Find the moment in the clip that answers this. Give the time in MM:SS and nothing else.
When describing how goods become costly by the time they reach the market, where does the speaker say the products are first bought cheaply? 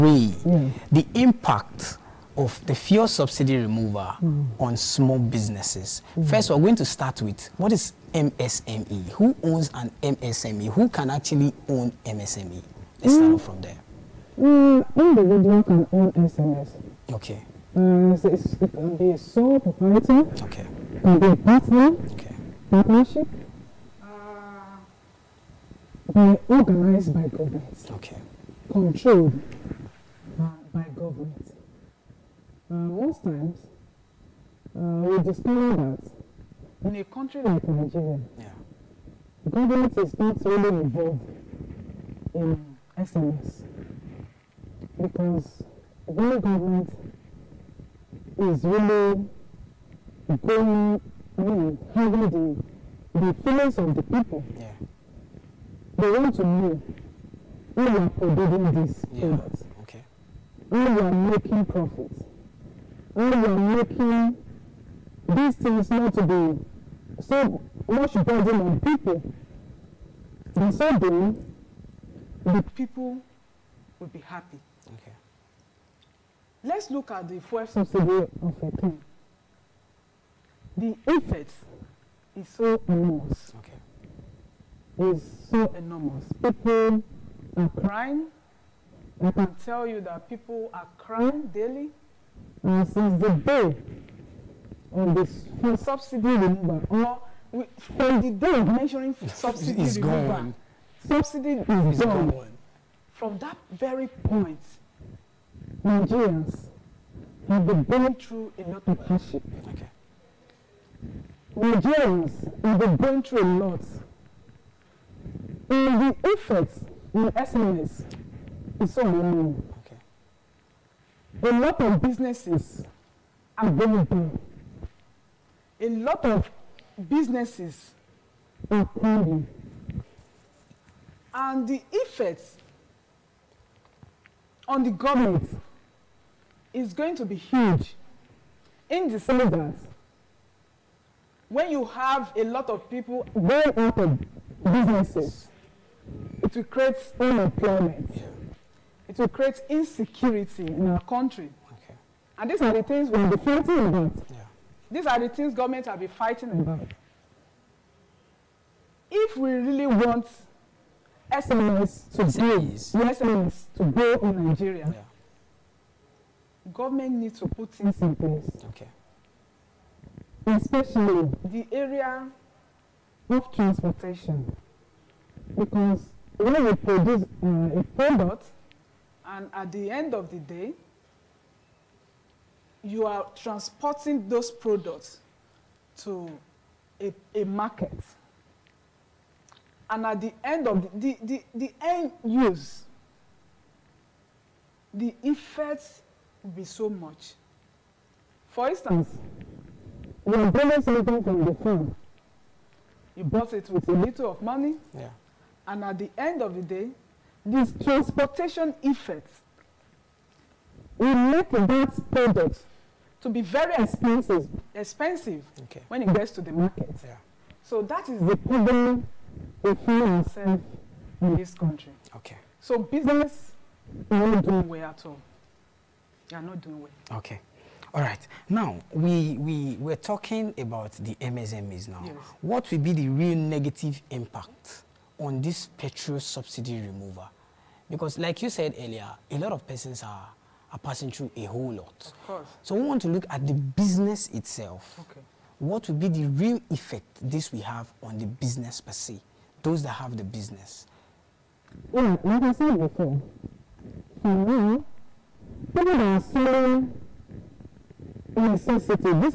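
03:21.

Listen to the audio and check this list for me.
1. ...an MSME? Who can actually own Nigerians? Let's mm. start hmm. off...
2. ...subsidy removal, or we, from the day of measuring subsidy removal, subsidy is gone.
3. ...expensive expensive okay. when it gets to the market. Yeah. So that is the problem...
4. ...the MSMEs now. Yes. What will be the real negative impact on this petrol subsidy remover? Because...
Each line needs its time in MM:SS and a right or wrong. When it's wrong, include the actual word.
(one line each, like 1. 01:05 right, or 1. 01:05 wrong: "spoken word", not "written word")
1. 00:09 wrong: "MSME", not "Nigerians"
2. 01:35 right
3. 03:33 right
4. 03:50 right.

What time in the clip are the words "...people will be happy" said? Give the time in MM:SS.
01:12.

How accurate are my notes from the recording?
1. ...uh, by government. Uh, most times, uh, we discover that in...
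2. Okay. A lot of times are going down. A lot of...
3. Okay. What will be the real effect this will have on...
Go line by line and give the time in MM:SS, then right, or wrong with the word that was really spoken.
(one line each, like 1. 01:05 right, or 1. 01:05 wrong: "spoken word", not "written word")
1. 00:30 right
2. 01:59 wrong: "businesses", not "times"
3. 04:05 right.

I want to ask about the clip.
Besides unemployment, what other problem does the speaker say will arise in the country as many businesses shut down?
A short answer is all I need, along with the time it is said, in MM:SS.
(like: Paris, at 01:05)
Insecurity, at 02:29.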